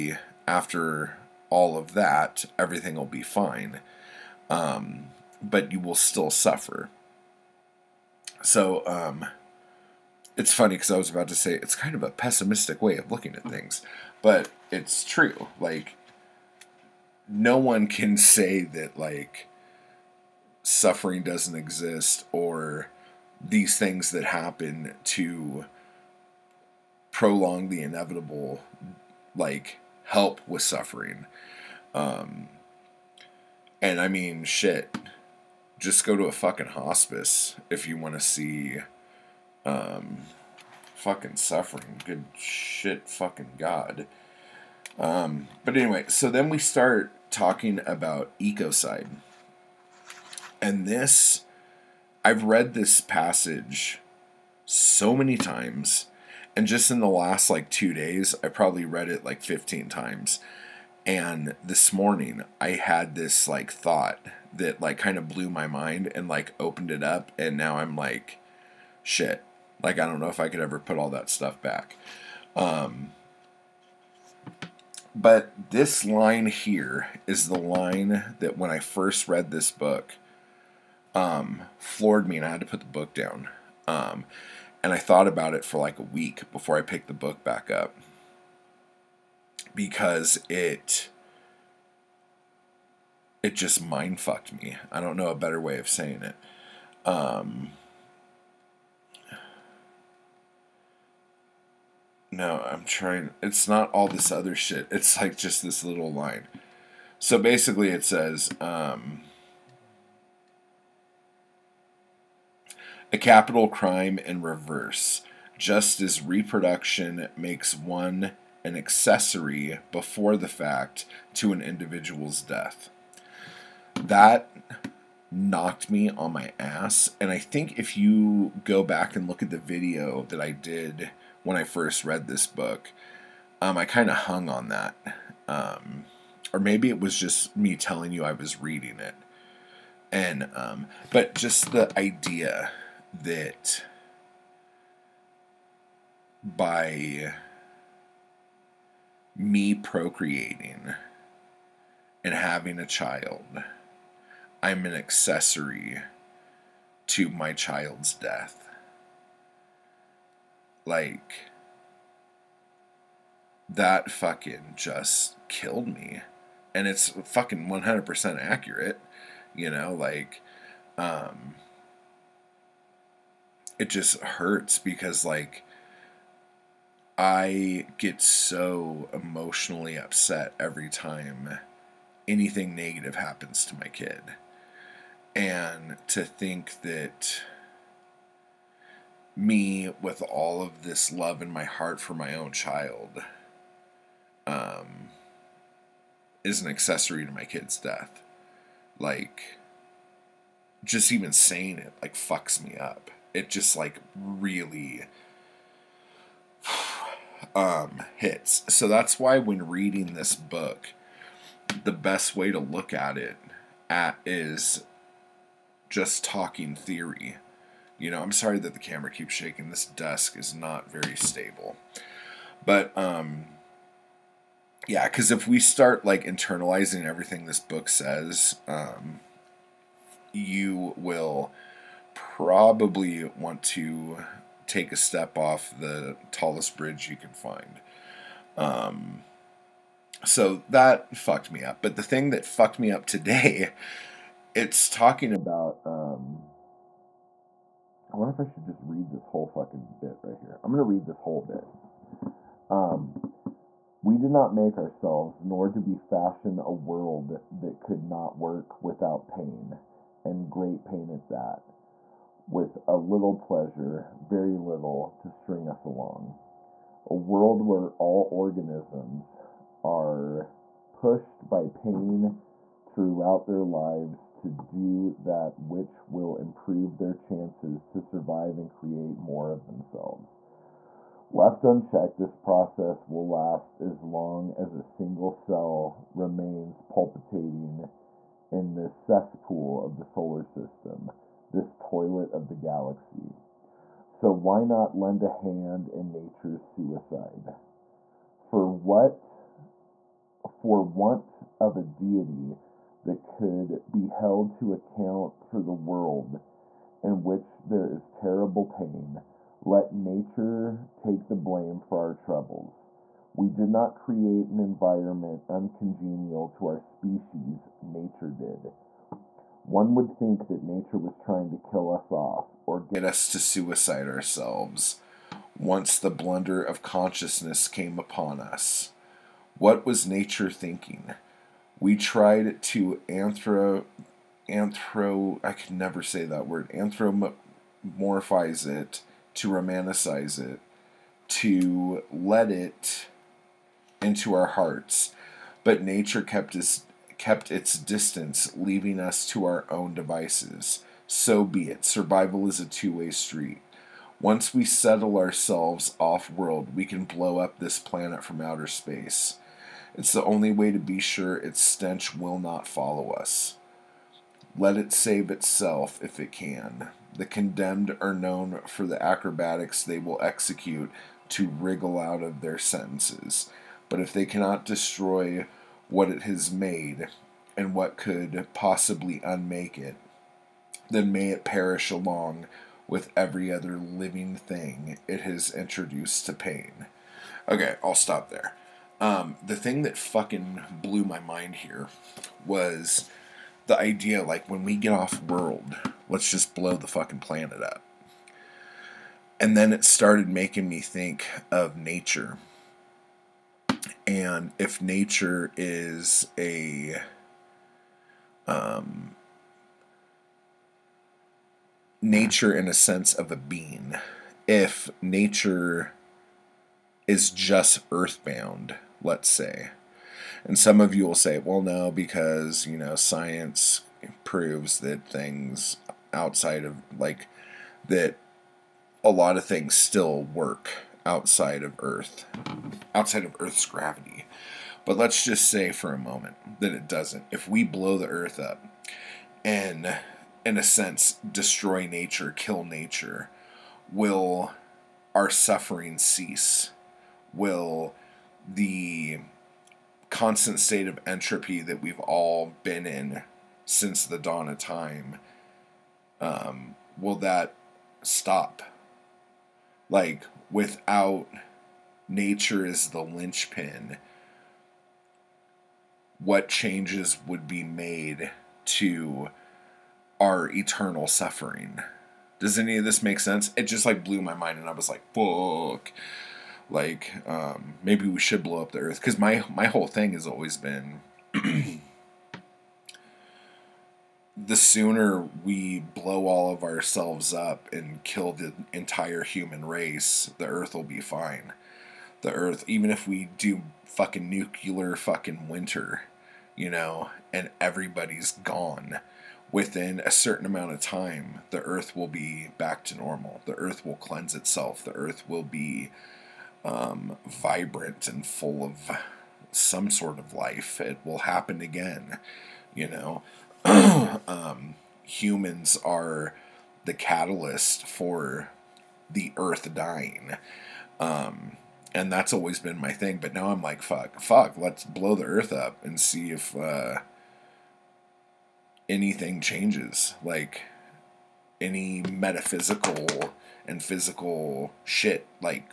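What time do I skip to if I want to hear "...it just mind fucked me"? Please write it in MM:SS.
01:33.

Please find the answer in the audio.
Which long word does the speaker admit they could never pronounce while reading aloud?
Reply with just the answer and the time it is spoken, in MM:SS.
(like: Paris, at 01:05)
anthropomorphize, at 05:36.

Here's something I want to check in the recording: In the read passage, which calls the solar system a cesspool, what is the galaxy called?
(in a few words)
toilet.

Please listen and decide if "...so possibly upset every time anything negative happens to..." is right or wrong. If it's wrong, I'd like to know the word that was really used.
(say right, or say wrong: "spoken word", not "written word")
wrong: "emotionally", not "possibly".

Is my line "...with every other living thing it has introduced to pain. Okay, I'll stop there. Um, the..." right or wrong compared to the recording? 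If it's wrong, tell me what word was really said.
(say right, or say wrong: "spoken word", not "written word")
right.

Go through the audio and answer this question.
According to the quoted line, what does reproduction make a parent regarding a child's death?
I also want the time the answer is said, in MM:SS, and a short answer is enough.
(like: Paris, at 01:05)
an accessory before the fact, at 01:58.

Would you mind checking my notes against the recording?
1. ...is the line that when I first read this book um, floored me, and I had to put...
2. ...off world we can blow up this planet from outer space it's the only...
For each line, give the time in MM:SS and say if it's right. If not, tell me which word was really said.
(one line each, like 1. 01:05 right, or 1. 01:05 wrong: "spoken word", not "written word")
1. 01:17 right
2. 05:55 right.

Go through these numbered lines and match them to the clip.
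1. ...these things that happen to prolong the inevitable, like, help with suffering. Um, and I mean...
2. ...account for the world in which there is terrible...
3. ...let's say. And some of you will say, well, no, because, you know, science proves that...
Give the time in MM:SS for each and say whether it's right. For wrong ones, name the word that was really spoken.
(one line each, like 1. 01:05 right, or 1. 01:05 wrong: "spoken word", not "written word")
1. 00:23 right
2. 05:04 right
3. 06:59 right.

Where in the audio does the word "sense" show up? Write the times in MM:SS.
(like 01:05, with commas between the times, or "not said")
06:52, 07:20, 07:53.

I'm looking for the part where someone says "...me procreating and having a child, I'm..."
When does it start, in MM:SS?
02:29.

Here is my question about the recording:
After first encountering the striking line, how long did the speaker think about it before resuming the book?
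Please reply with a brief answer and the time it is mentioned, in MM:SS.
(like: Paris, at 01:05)
a week, at 01:25.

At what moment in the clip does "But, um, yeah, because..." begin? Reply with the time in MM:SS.
03:42.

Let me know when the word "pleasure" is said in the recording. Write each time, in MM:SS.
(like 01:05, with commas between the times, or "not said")
04:23.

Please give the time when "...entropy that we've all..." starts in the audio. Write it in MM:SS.
07:31.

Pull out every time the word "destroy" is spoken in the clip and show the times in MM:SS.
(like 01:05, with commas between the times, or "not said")
06:14, 07:21.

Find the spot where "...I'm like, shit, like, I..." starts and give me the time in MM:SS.
01:07.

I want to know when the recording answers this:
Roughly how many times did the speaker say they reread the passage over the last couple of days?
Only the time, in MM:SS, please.
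00:59.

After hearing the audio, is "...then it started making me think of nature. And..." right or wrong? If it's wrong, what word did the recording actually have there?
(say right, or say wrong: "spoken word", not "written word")
right.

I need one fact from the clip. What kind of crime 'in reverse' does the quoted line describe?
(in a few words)
capital crime.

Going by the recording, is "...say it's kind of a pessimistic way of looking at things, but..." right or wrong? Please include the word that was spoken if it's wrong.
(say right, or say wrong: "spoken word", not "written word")
right.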